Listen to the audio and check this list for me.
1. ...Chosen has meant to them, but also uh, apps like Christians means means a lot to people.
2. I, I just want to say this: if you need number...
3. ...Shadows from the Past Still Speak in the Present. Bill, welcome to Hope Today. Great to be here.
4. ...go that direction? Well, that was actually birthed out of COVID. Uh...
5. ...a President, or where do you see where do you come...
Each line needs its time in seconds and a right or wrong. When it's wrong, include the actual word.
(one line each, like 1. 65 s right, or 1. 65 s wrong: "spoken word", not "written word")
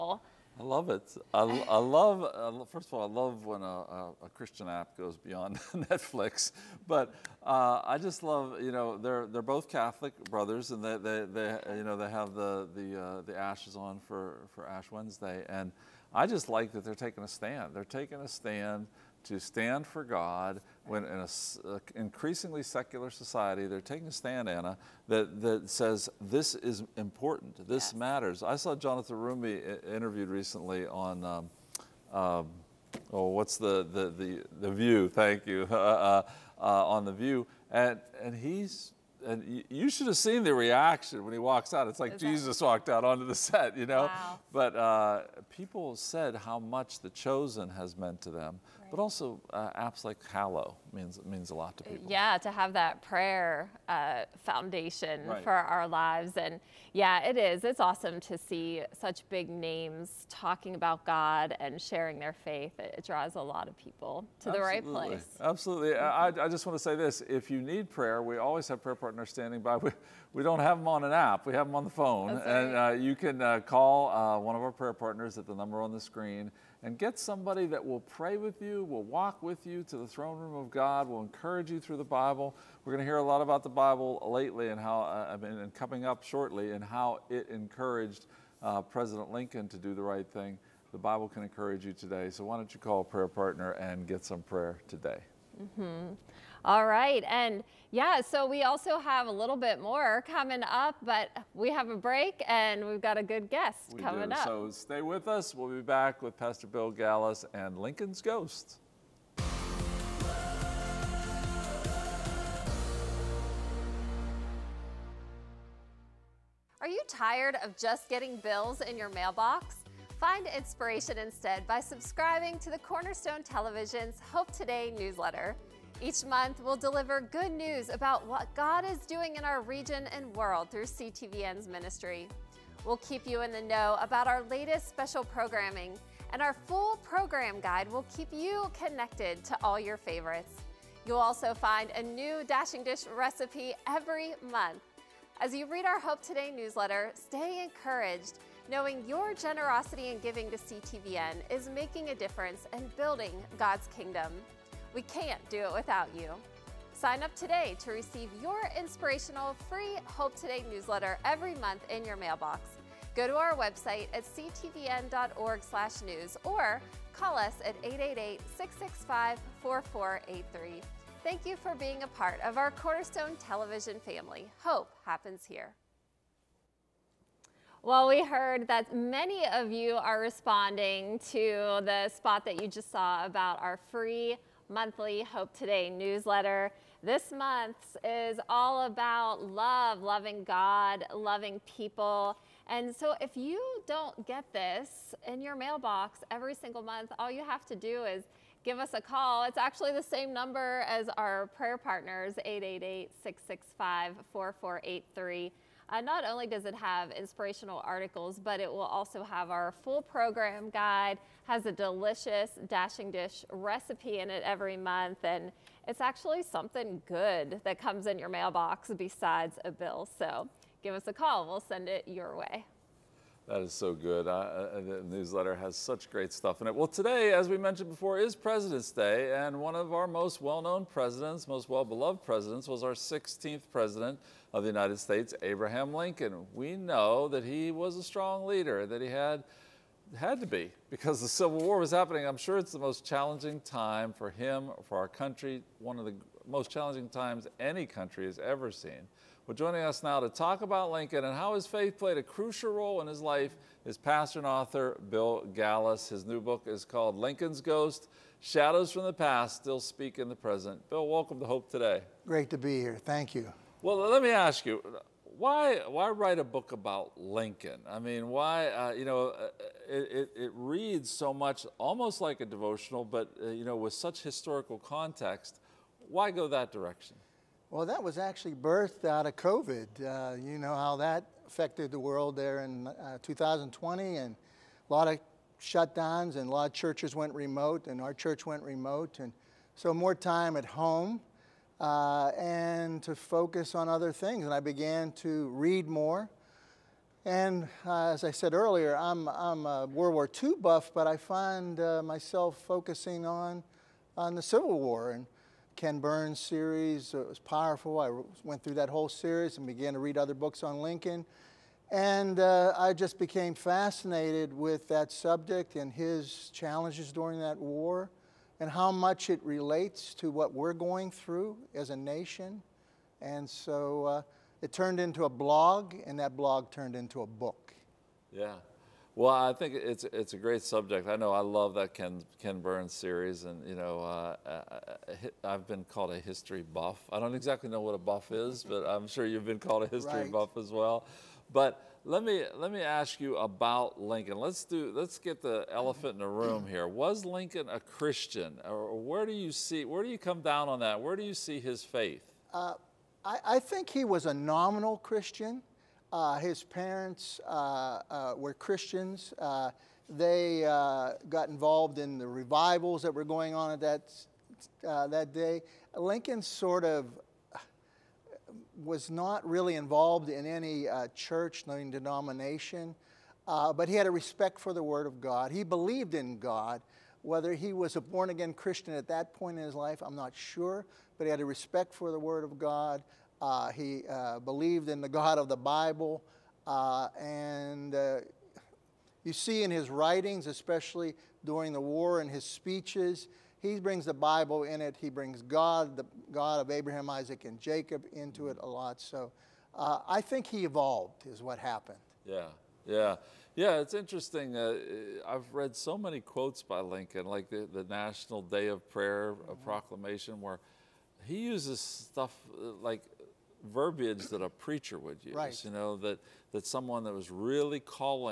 1. 47 s wrong: "Hallow", not "Christians"
2. 66 s wrong: "prayer", not "number"
3. 258 s right
4. 276 s right
5. 347 s wrong: "Christian", not "President".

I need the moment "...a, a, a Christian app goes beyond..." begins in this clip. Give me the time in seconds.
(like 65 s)
3 s.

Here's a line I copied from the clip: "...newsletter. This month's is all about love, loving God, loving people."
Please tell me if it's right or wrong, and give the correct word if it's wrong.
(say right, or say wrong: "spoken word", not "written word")
right.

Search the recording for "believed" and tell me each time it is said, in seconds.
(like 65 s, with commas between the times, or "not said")
375 s, 384 s.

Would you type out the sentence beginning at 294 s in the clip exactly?
And I began to read more.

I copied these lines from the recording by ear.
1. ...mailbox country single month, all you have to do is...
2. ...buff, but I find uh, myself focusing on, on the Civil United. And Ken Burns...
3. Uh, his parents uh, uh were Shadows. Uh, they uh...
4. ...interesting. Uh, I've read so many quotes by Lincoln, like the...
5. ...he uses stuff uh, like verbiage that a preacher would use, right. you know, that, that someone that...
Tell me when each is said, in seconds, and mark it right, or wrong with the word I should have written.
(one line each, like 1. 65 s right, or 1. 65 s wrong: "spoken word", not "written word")
1. 195 s wrong: "every", not "country"
2. 300 s wrong: "War", not "United"
3. 356 s wrong: "Christians", not "Shadows"
4. 403 s right
5. 411 s right.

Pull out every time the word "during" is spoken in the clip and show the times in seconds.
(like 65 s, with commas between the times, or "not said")
317 s, 391 s.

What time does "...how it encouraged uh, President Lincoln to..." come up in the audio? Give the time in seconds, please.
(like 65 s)
86 s.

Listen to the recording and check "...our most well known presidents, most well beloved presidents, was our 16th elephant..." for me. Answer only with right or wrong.
wrong.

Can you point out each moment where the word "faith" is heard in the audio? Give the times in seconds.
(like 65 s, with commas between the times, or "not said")
62 s, 251 s, 351 s.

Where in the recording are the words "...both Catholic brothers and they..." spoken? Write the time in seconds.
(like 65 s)
9 s.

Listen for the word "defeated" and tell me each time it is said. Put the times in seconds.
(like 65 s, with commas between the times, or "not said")
not said.